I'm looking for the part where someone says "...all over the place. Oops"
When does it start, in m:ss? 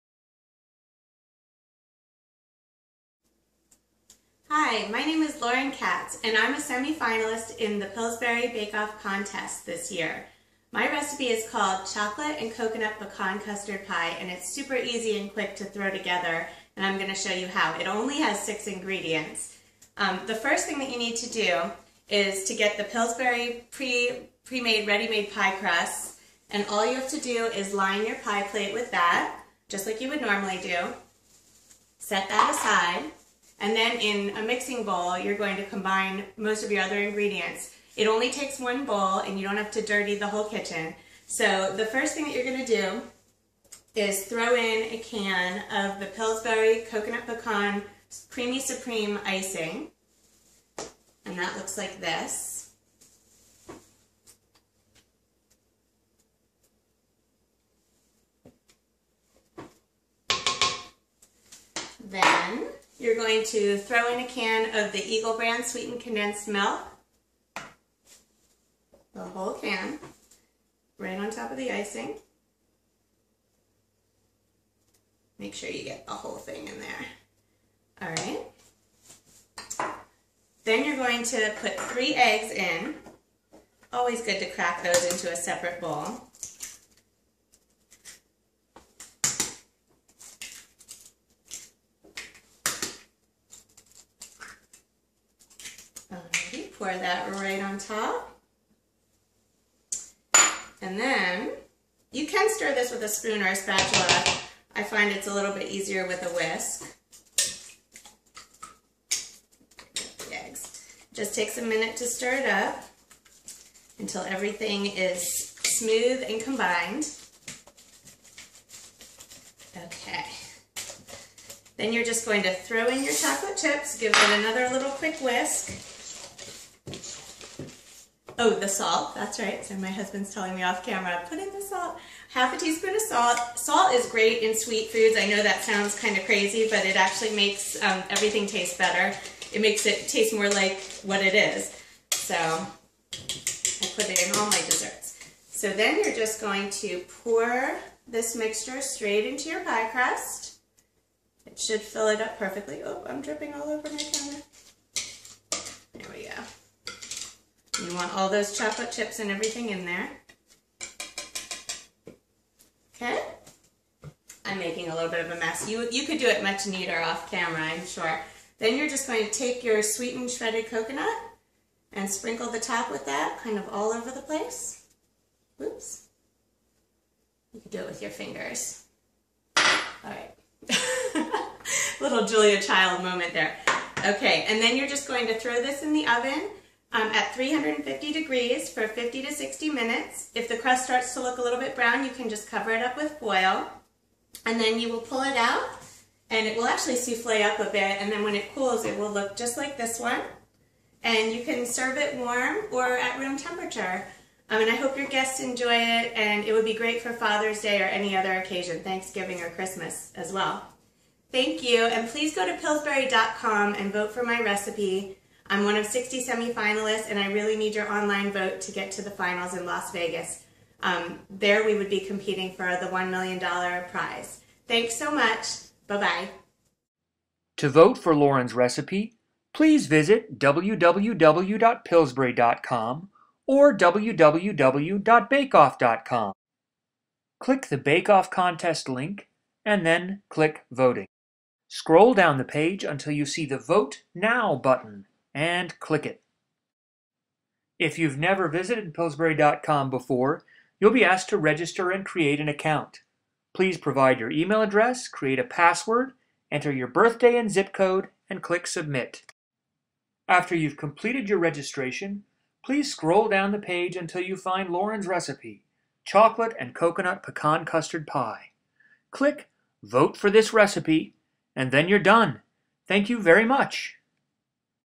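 2:53.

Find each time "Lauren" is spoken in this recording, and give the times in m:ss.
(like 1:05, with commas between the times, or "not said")
0:05, 3:48, 4:24.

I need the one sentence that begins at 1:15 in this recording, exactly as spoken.
Make sure you get the whole thing in there.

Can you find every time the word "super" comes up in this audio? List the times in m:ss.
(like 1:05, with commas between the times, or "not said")
0:14.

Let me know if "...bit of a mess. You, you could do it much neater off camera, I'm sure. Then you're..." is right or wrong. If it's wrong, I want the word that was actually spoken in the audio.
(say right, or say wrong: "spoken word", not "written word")
right.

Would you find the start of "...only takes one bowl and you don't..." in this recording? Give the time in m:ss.
0:38.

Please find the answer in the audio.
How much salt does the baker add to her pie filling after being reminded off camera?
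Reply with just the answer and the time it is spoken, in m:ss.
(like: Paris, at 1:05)
half a teaspoon, at 2:12.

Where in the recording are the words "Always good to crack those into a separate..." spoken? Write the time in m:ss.
1:23.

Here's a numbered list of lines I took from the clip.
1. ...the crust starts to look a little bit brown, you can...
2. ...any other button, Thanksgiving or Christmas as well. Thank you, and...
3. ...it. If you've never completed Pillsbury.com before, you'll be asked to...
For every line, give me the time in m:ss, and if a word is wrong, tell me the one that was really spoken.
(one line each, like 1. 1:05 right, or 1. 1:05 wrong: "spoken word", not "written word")
1. 3:10 right
2. 3:27 wrong: "occasion", not "button"
3. 4:06 wrong: "visited", not "completed".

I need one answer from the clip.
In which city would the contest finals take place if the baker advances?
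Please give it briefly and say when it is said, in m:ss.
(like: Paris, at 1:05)
Las Vegas, at 3:39.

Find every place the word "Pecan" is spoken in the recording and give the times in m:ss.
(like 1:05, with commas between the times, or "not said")
0:12, 0:47, 4:27.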